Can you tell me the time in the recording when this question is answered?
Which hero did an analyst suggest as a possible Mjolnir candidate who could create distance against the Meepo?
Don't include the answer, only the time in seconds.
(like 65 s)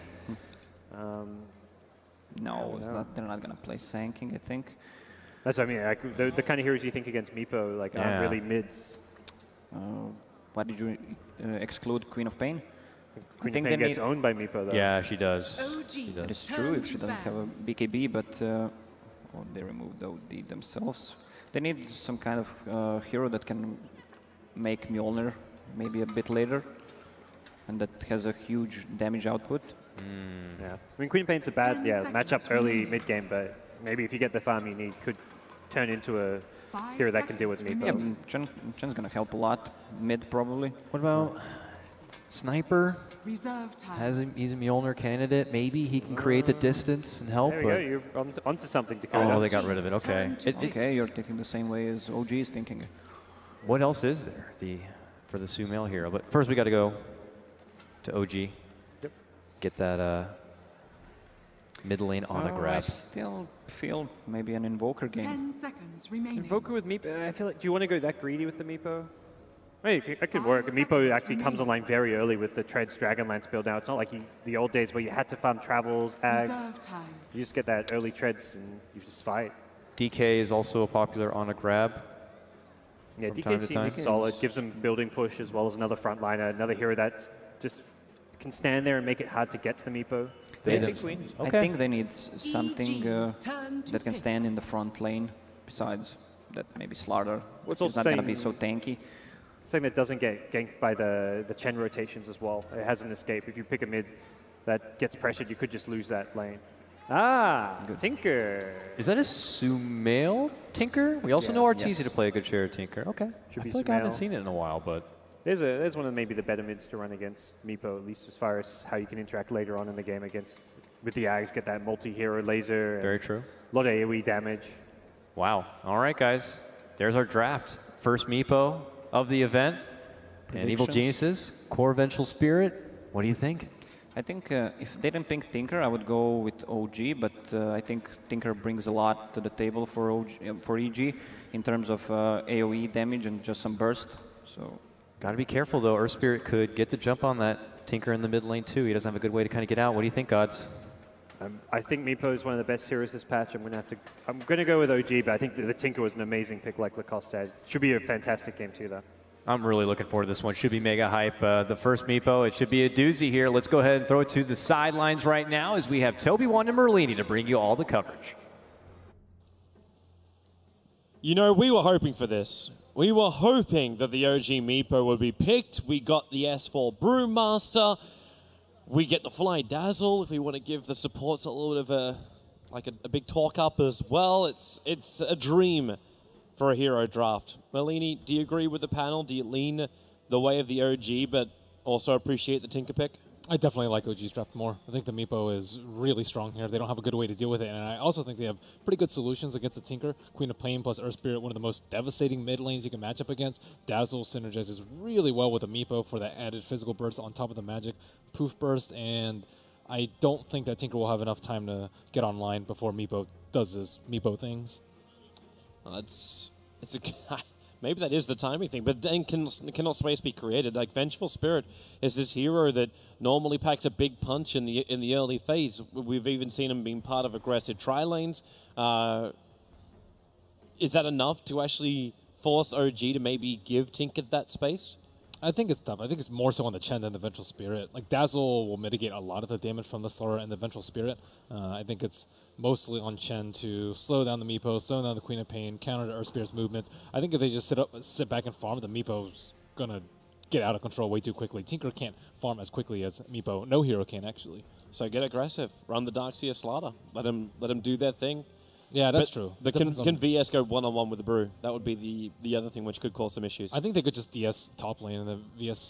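42 s.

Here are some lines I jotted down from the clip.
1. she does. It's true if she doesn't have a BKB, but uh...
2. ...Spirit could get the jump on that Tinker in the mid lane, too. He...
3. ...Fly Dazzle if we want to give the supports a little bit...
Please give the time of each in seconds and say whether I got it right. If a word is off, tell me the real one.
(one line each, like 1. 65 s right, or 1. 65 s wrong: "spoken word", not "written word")
1. 15 s right
2. 146 s right
3. 179 s right.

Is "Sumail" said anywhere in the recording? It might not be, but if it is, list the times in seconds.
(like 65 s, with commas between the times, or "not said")
55 s, 109 s.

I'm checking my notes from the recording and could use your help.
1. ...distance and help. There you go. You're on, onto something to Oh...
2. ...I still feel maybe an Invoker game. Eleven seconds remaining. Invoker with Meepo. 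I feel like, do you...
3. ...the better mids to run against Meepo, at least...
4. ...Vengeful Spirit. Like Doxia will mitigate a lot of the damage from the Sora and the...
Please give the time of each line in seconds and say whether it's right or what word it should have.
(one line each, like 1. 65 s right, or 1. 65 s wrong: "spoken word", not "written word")
1. 46 s right
2. 62 s wrong: "Ten", not "Eleven"
3. 116 s right
4. 237 s wrong: "Dazzle", not "Doxia".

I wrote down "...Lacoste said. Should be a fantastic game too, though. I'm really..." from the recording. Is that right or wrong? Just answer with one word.
right.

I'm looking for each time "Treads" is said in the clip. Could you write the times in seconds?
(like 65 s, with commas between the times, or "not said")
72 s, 78 s.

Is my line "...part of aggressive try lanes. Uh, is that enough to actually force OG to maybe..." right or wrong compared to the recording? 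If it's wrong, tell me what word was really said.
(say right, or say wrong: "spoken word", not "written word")
right.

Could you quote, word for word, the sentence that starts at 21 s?
They need some kind of uh, hero that can make Mjolnir maybe a bit later, and that has a huge damage output.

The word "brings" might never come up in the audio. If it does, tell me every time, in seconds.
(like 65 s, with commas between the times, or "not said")
138 s, 167 s.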